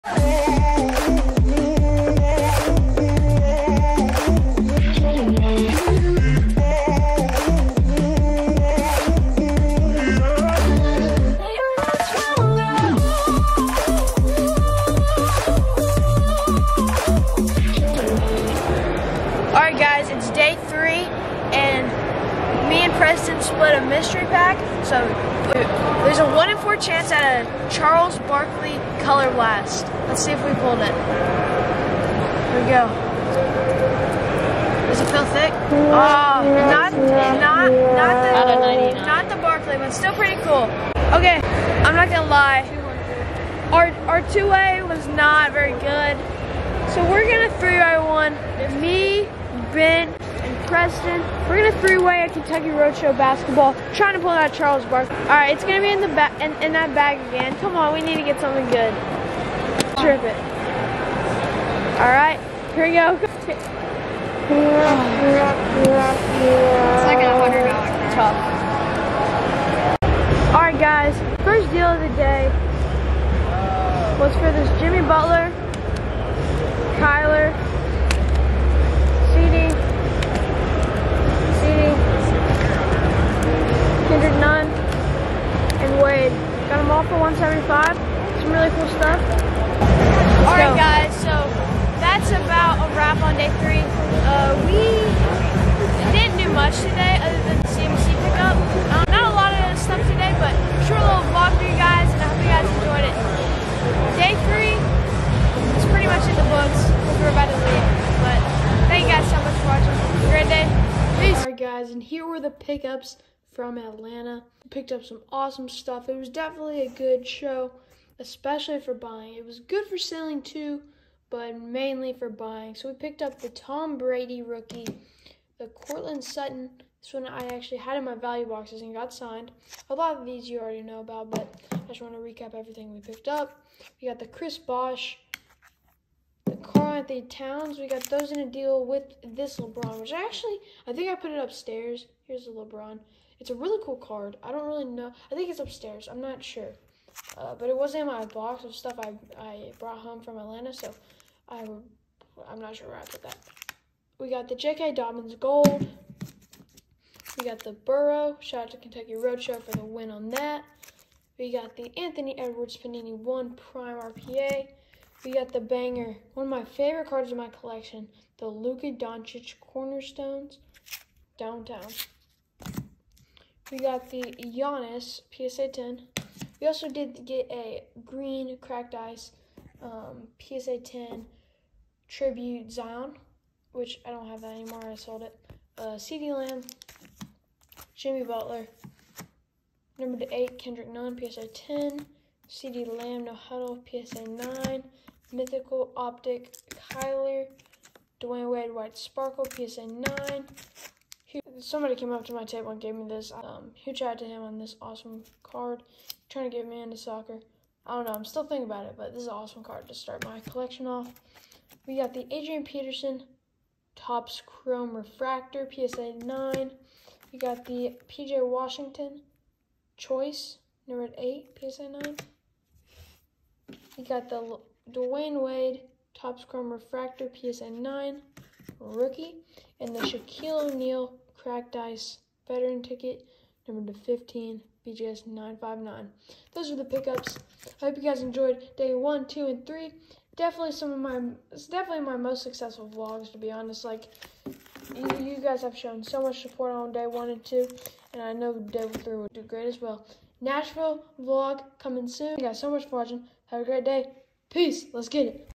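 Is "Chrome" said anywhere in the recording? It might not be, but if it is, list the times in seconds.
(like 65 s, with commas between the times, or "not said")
214 s, 226 s.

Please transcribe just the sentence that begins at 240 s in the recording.
Definitely some of my, it's definitely my most successful vlogs, to be honest.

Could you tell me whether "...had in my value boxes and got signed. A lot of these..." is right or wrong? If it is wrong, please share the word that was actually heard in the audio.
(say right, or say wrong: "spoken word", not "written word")
right.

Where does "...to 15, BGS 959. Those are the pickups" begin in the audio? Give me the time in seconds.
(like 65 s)
233 s.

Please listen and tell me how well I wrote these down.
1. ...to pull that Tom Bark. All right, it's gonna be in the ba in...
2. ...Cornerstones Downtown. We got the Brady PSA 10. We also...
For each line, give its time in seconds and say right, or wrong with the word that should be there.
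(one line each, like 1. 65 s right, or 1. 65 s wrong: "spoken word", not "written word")
1. 54 s wrong: "Charles", not "Tom"
2. 169 s wrong: "Giannis", not "Brady".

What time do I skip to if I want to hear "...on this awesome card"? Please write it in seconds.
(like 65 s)
204 s.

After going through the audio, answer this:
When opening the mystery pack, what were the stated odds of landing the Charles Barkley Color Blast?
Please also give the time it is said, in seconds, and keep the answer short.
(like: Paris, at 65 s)
1 in 4, at 26 s.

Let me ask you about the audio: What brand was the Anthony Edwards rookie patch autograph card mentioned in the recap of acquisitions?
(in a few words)
Panini 1.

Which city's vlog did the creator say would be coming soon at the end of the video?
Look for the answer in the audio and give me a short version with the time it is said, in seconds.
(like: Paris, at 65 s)
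Nashville, at 250 s.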